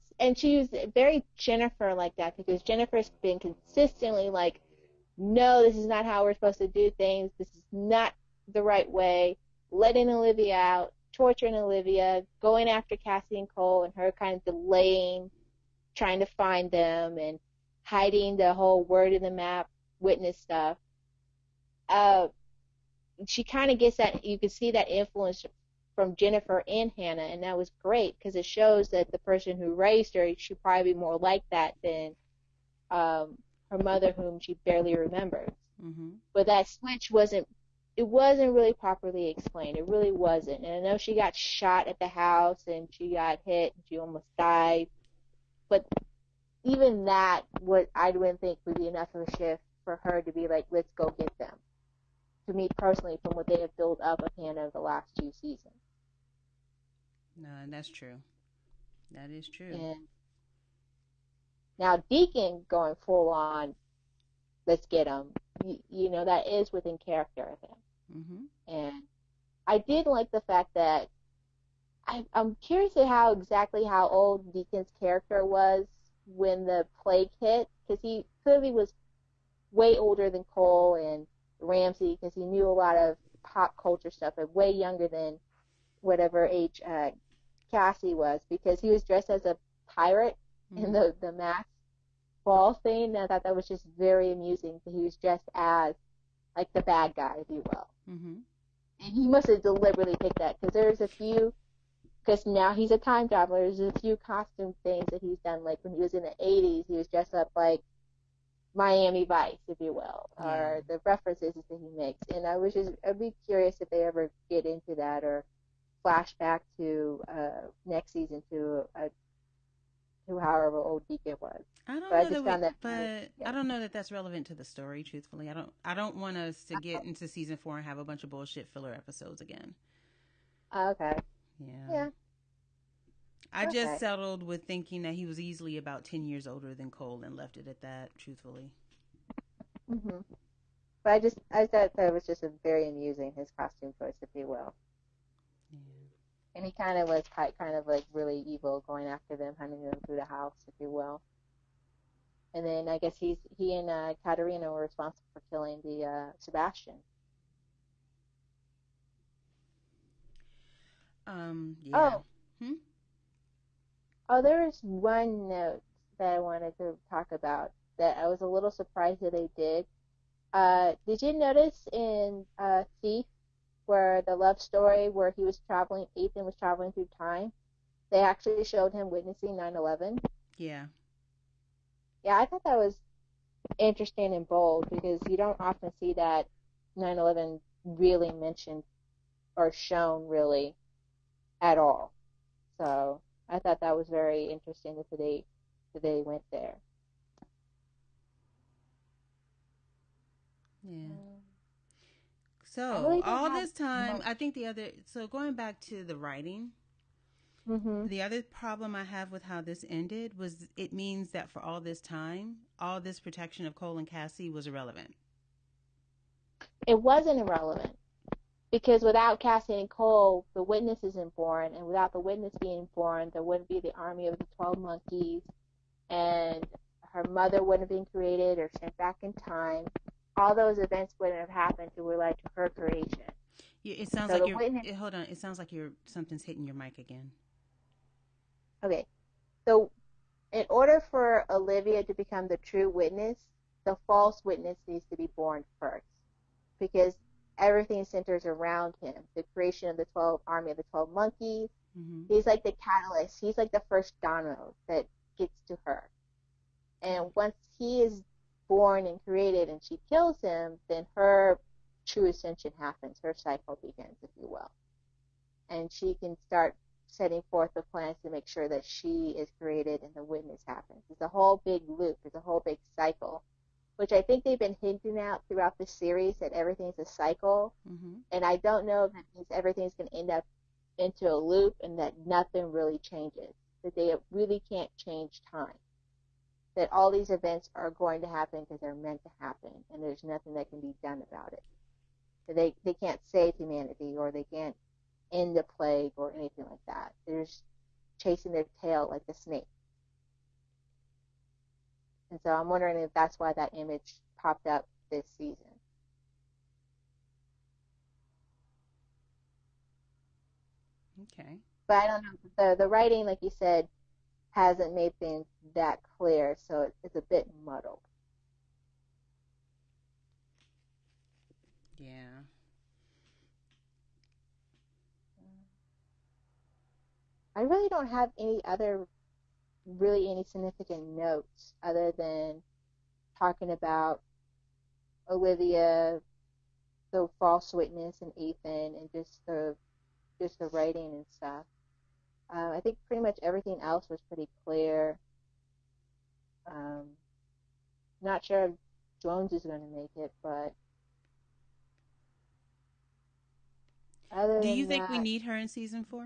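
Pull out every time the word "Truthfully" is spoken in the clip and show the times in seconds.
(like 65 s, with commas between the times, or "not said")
125 s, 138 s.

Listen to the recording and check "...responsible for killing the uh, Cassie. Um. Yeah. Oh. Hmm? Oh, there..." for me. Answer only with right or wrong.
wrong.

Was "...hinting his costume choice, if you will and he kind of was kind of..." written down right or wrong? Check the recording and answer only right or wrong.
wrong.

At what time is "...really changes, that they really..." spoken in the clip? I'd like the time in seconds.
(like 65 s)
282 s.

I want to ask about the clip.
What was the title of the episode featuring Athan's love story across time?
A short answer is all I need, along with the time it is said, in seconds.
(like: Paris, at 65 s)
Thief, at 173 s.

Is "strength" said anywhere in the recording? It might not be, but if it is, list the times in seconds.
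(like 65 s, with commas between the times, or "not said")
not said.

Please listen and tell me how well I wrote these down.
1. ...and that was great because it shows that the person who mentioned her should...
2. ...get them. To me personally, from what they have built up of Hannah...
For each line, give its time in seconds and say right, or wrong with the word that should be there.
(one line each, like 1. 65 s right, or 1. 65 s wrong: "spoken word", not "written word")
1. 27 s wrong: "raised", not "mentioned"
2. 51 s right.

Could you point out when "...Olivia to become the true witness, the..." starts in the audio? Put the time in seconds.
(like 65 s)
241 s.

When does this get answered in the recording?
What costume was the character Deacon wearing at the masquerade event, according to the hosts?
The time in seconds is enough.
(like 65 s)
89 s.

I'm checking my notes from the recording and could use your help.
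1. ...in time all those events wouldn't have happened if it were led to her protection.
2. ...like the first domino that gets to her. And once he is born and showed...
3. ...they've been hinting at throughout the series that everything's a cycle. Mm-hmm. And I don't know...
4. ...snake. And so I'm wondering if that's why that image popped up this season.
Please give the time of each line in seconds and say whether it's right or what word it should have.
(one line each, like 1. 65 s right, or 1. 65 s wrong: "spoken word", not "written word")
1. 229 s wrong: "creation", not "protection"
2. 253 s wrong: "created", not "showed"
3. 274 s right
4. 299 s right.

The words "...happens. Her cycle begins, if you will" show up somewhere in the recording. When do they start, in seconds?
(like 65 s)
262 s.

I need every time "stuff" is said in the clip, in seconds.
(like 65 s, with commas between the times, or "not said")
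20 s, 84 s, 341 s.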